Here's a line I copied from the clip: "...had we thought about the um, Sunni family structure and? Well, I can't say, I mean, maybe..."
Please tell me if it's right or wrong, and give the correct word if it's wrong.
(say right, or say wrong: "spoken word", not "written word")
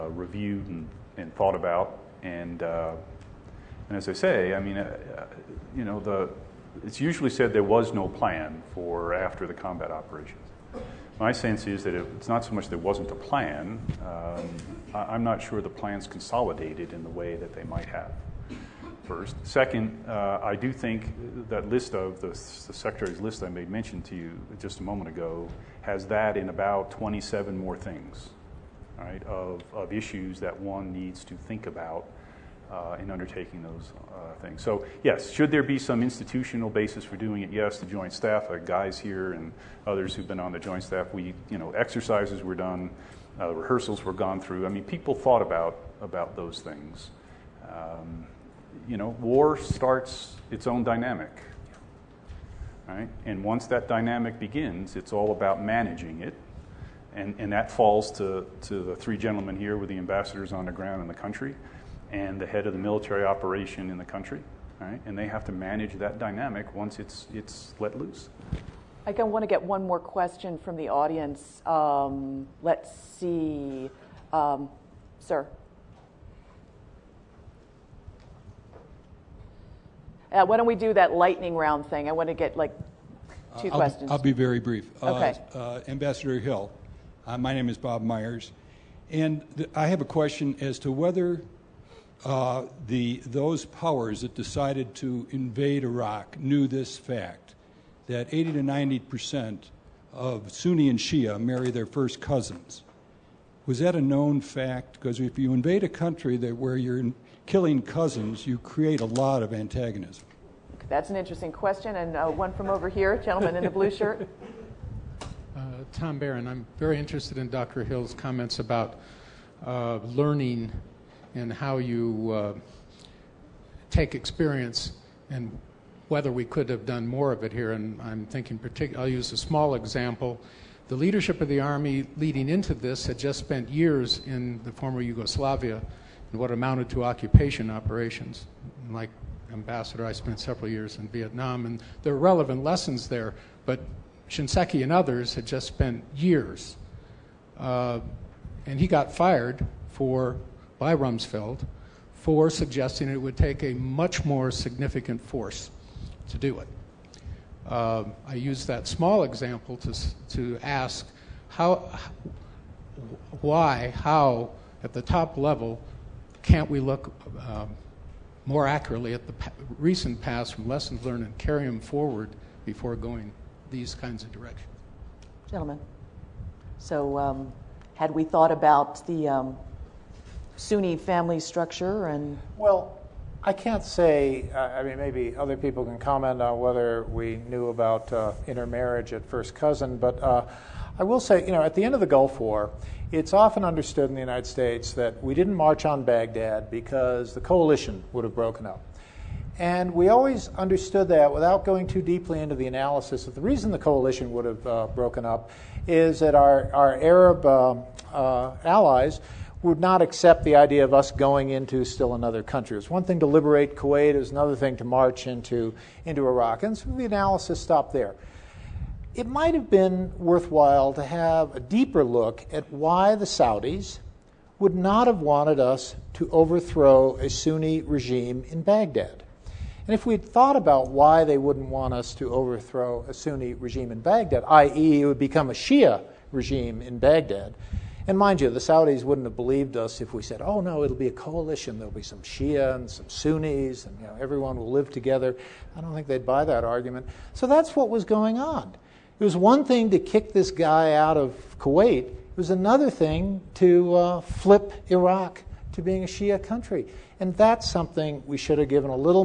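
right.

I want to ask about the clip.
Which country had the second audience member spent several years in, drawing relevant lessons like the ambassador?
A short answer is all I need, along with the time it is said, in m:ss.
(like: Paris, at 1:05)
Vietnam, at 2:21.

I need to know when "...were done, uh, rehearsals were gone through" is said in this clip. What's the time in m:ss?
0:42.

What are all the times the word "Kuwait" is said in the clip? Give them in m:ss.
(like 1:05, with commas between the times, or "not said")
3:33, 4:11.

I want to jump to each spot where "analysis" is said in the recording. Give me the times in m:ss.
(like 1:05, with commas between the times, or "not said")
3:22, 3:37.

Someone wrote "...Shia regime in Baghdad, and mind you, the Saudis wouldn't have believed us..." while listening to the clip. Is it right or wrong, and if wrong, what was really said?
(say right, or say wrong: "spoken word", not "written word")
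right.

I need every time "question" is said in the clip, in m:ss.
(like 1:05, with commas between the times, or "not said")
1:09, 1:23, 1:30, 1:51.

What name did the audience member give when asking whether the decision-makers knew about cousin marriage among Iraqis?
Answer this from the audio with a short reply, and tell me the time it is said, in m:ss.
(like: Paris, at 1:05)
Bob Myers, at 1:27.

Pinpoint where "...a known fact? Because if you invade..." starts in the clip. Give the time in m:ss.
1:43.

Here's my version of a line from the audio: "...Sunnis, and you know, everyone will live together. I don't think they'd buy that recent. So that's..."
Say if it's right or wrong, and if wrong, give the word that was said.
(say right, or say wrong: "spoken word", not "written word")
wrong: "argument", not "recent".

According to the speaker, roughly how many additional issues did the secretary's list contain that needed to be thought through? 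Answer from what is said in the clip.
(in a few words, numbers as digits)
27.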